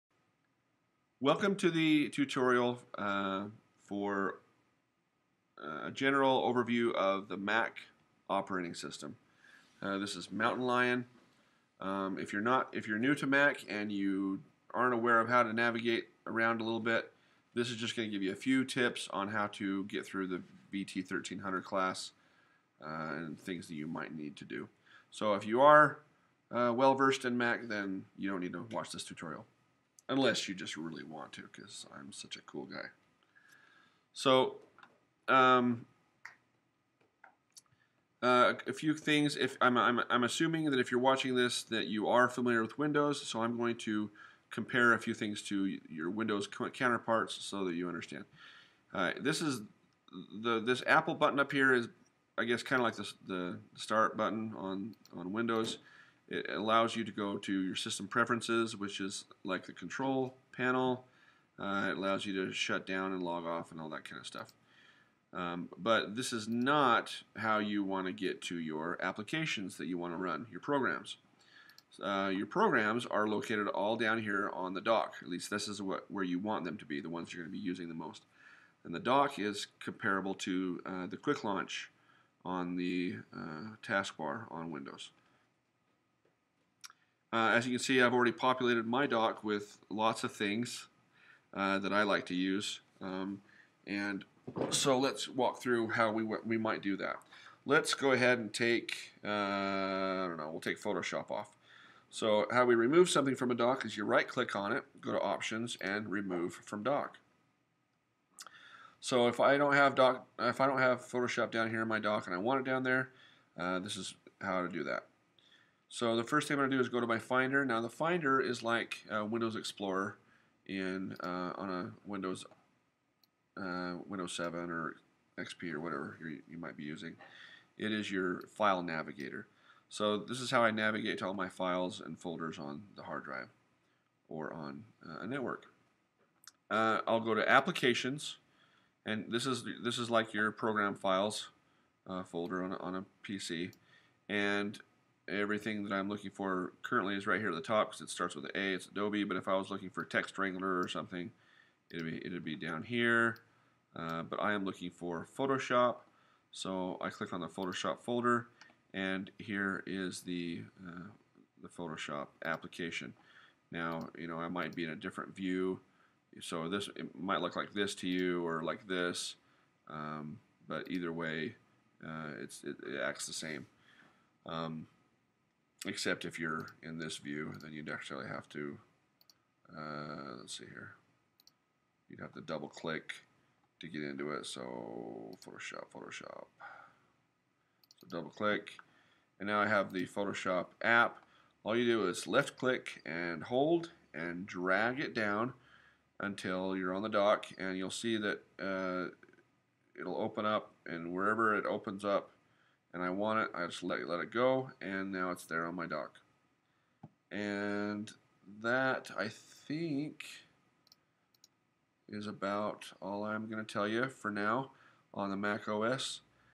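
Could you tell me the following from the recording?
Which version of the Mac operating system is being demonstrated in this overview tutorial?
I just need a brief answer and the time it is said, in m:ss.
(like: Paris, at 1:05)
Mountain Lion, at 0:10.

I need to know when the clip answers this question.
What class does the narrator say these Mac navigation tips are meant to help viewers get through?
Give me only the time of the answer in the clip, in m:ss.
0:20.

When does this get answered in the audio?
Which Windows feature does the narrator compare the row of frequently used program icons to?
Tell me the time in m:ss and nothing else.
1:21.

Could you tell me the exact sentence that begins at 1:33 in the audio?
Um, and so let's walk through how we, we might do that.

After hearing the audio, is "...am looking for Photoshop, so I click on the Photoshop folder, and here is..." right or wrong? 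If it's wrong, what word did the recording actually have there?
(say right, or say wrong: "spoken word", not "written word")
right.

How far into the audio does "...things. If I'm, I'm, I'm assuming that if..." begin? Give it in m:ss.
0:38.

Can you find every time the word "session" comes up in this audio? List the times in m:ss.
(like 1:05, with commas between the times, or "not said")
not said.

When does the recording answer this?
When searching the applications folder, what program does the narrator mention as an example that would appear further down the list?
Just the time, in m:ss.
2:30.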